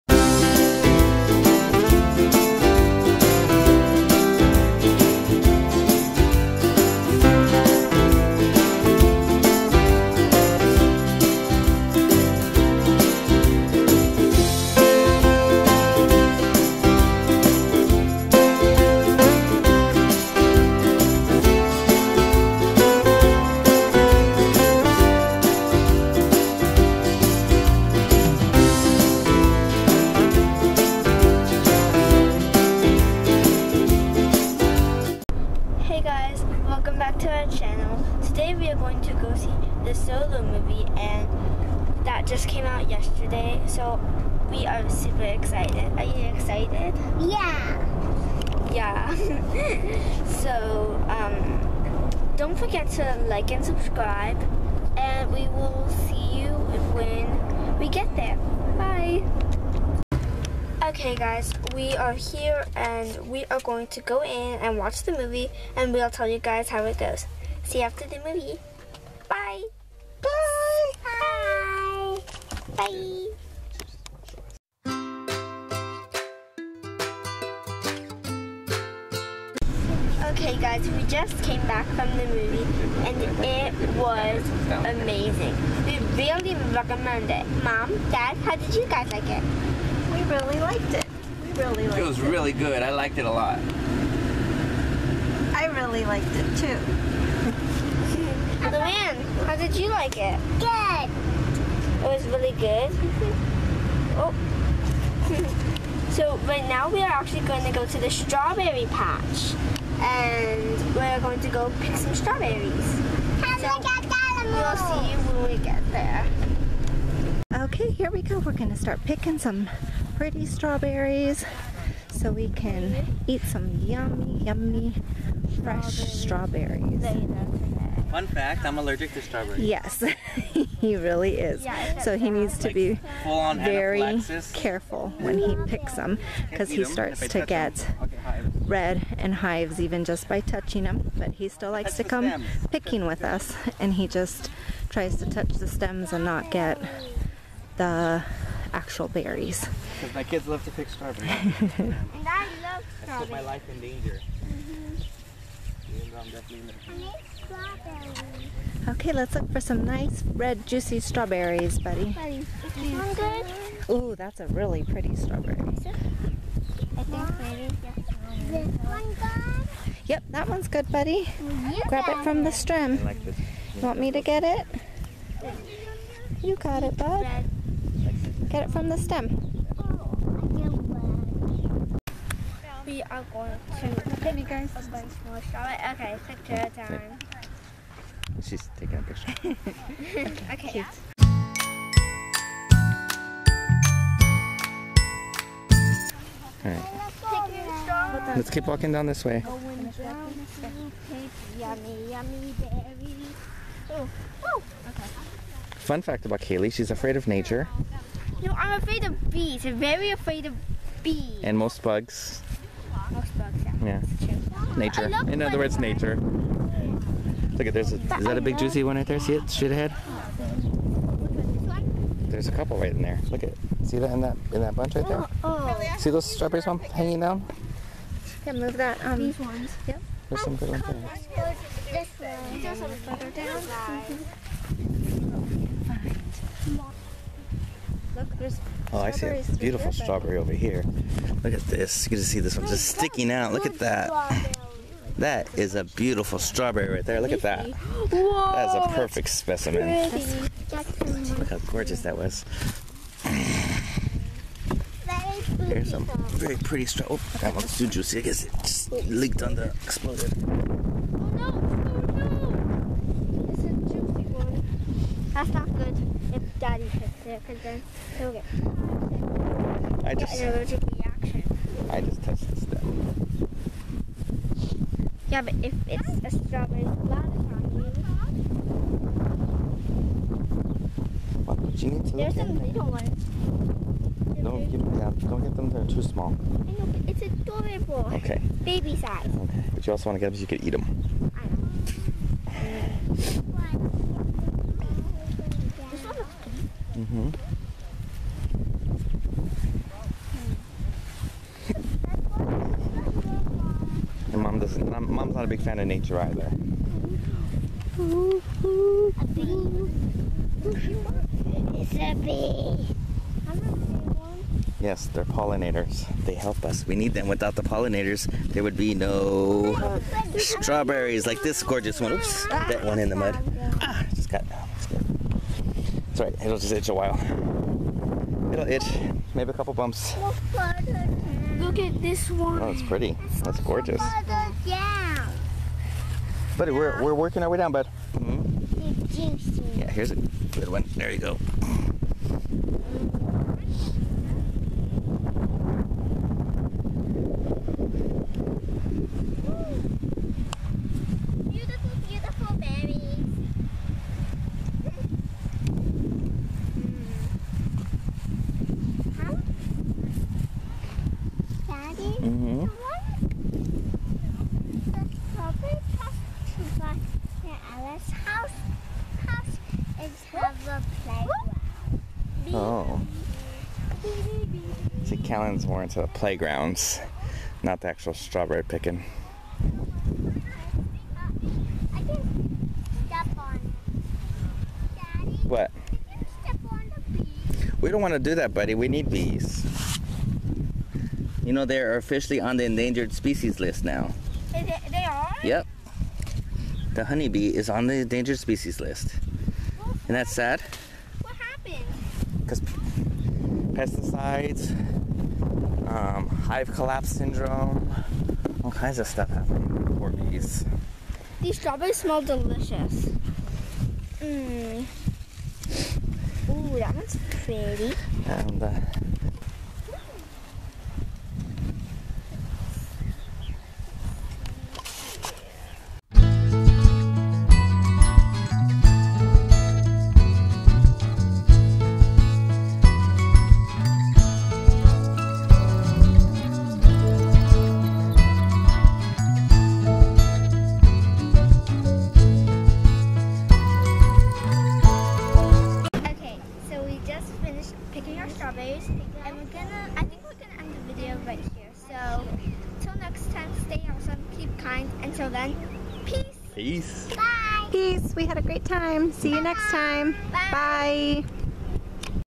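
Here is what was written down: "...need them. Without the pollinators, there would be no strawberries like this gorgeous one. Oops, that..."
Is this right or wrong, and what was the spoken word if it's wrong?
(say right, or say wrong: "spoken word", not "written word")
right.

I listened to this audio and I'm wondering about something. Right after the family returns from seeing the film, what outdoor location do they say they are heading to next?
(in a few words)
strawberry patch.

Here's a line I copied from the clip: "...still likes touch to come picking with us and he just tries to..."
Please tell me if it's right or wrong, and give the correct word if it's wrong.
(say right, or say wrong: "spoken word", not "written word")
right.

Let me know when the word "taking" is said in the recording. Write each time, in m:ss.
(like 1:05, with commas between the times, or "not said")
3:08.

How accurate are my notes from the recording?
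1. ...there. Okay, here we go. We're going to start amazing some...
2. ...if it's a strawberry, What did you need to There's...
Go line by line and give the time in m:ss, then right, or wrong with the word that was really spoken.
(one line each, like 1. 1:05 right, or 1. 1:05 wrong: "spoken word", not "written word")
1. 1:55 wrong: "picking", not "amazing"
2. 4:35 right.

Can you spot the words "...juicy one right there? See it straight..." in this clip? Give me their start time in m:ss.
3:38.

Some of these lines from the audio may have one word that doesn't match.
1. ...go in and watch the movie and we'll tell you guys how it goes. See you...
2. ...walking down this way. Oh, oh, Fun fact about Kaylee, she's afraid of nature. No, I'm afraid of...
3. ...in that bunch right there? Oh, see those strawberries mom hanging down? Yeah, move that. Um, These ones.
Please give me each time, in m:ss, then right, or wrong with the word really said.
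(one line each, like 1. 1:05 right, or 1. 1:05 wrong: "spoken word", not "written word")
1. 1:04 right
2. 3:18 right
3. 3:44 right.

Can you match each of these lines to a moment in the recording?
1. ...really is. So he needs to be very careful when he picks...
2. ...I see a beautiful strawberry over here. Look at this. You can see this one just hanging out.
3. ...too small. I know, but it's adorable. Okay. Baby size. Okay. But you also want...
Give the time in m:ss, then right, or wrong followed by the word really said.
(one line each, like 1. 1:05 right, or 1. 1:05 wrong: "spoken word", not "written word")
1. 2:10 right
2. 3:58 wrong: "sticking", not "hanging"
3. 4:45 right.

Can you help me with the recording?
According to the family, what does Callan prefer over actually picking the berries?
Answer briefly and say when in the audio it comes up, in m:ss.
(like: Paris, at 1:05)
playgrounds, at 6:16.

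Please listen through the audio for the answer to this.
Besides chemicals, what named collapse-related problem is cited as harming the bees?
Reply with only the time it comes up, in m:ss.
6:46.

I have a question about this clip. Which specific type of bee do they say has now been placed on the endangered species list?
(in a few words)
honeybee.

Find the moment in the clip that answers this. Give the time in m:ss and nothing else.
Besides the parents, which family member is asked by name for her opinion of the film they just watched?
1:38.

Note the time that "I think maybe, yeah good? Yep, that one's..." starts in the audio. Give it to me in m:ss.
2:45.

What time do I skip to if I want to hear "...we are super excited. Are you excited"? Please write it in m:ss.
0:44.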